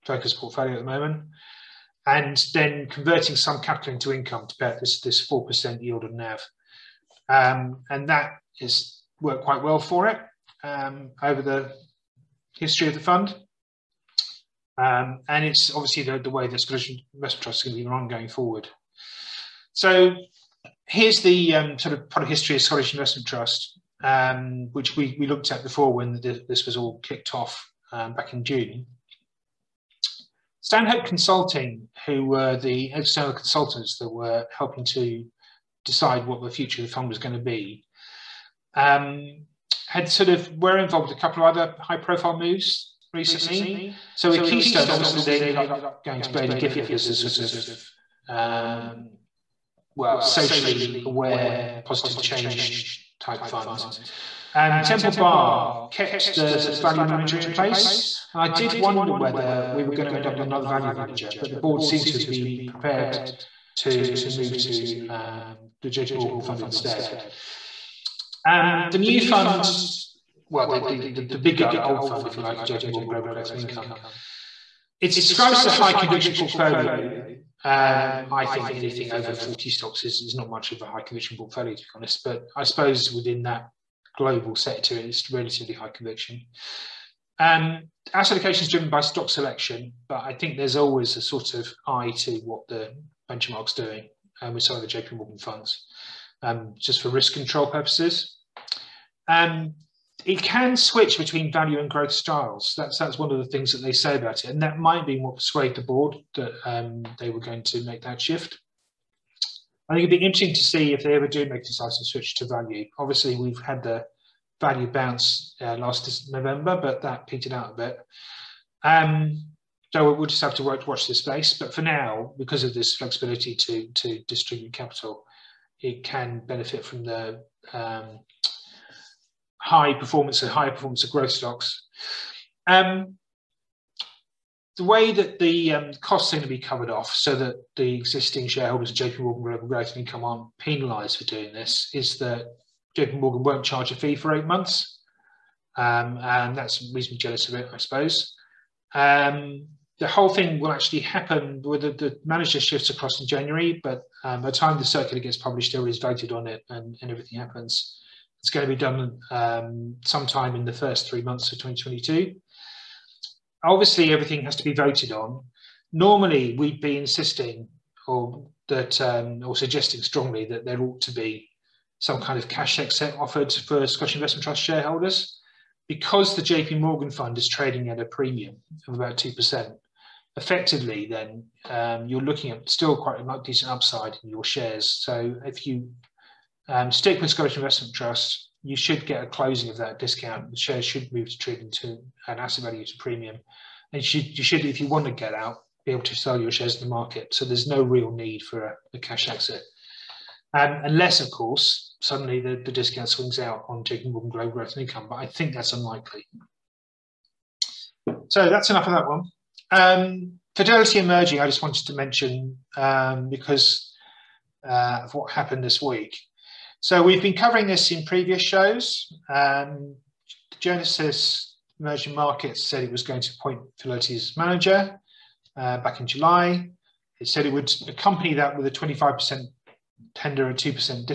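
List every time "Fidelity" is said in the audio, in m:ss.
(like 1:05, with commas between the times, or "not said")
3:30, 3:43.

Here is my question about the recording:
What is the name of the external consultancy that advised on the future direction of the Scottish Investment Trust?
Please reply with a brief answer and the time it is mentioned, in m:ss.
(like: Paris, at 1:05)
Stanhope Consulting, at 0:30.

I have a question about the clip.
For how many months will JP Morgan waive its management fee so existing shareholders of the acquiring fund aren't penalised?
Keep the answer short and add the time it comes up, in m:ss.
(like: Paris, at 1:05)
8, at 2:24.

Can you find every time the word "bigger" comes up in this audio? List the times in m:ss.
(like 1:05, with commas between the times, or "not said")
1:11.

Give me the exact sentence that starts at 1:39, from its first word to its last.
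Um, it can switch between value and growth styles.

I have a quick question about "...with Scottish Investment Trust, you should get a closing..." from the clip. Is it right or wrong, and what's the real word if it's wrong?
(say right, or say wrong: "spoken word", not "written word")
right.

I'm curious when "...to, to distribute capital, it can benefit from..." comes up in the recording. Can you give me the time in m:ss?
2:03.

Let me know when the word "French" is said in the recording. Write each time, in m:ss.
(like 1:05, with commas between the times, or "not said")
not said.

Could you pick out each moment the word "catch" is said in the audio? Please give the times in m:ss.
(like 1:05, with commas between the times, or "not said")
not said.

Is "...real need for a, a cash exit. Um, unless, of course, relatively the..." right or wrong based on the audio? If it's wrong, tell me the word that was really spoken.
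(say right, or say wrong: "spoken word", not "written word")
wrong: "suddenly", not "relatively".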